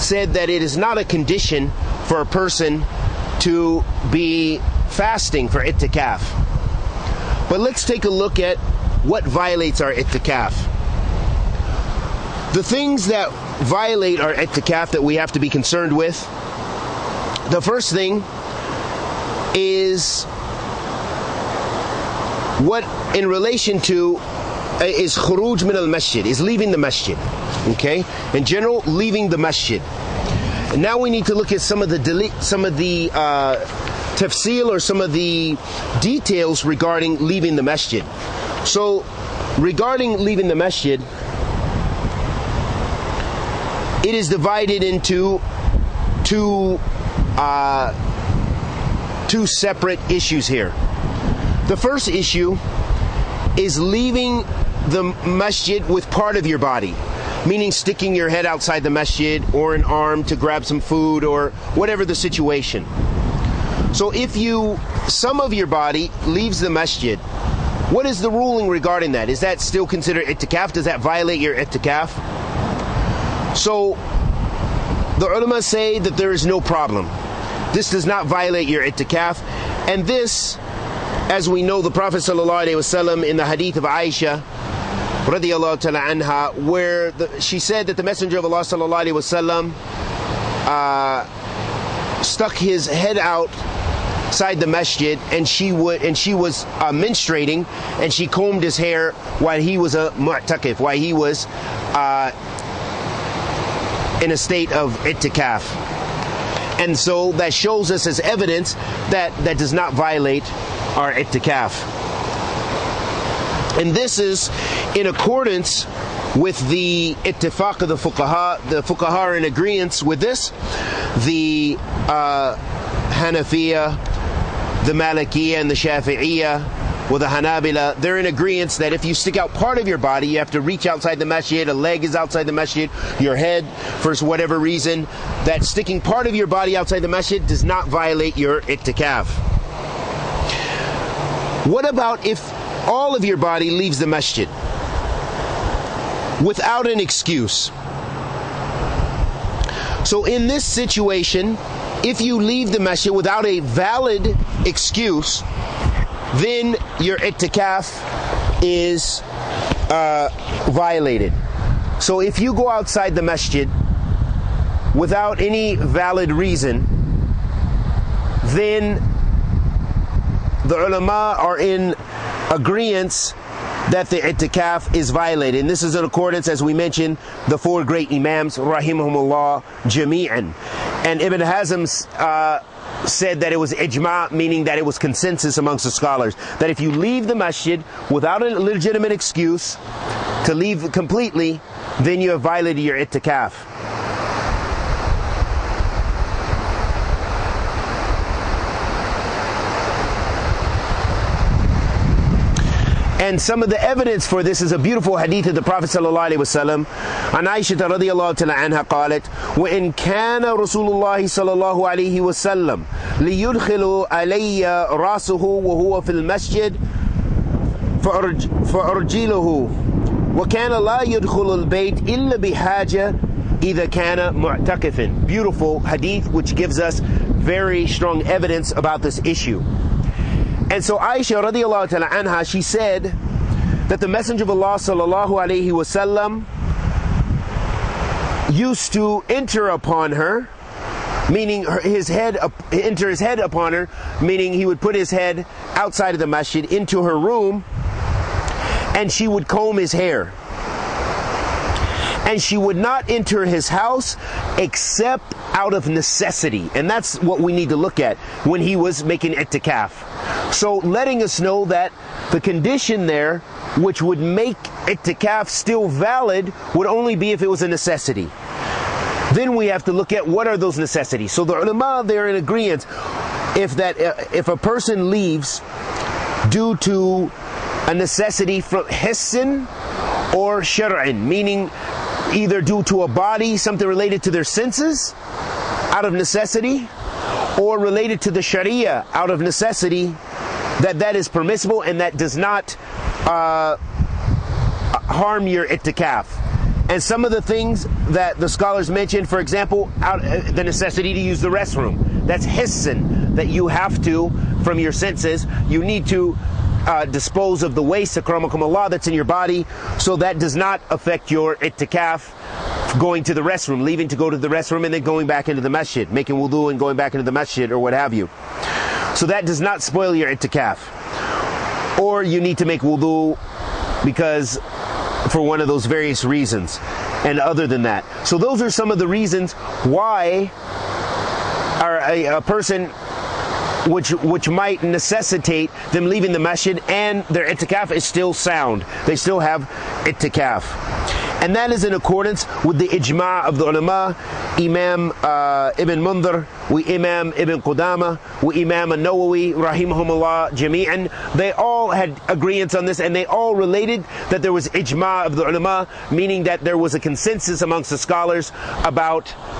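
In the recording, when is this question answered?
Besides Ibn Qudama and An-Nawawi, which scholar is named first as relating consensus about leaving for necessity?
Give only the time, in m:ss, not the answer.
5:45.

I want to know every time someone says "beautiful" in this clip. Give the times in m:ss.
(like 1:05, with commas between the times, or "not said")
3:24, 3:45.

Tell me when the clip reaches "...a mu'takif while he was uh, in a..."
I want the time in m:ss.
1:39.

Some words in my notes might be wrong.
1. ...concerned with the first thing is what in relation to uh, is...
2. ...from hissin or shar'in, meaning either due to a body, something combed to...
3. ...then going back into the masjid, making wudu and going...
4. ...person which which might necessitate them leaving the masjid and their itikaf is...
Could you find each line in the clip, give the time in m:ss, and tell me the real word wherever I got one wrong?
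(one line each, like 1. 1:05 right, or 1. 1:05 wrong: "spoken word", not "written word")
1. 0:15 right
2. 4:38 wrong: "related", not "combed"
3. 5:14 right
4. 5:32 right.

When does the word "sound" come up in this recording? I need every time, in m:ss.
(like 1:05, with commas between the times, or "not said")
5:38.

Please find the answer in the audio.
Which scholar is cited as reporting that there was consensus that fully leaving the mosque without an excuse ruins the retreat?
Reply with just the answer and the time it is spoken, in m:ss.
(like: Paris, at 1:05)
Ibn Hazm, at 3:01.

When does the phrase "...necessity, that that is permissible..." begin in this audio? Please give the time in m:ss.
4:49.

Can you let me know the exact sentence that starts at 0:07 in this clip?
But let's take a look at what violates our ittikaf.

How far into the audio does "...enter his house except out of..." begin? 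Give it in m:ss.
4:13.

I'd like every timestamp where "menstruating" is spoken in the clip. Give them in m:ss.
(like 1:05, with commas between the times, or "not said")
1:36.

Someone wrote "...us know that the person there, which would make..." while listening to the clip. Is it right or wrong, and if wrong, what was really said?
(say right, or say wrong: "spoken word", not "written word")
wrong: "condition", not "person".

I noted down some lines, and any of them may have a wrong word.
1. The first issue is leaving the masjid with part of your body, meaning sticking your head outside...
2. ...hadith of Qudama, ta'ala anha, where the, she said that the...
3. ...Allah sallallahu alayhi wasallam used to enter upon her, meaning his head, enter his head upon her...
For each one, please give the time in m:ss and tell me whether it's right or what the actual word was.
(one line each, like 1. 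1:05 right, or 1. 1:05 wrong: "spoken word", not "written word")
1. 0:51 right
2. 1:23 wrong: "Aisha", not "Qudama"
3. 3:54 right.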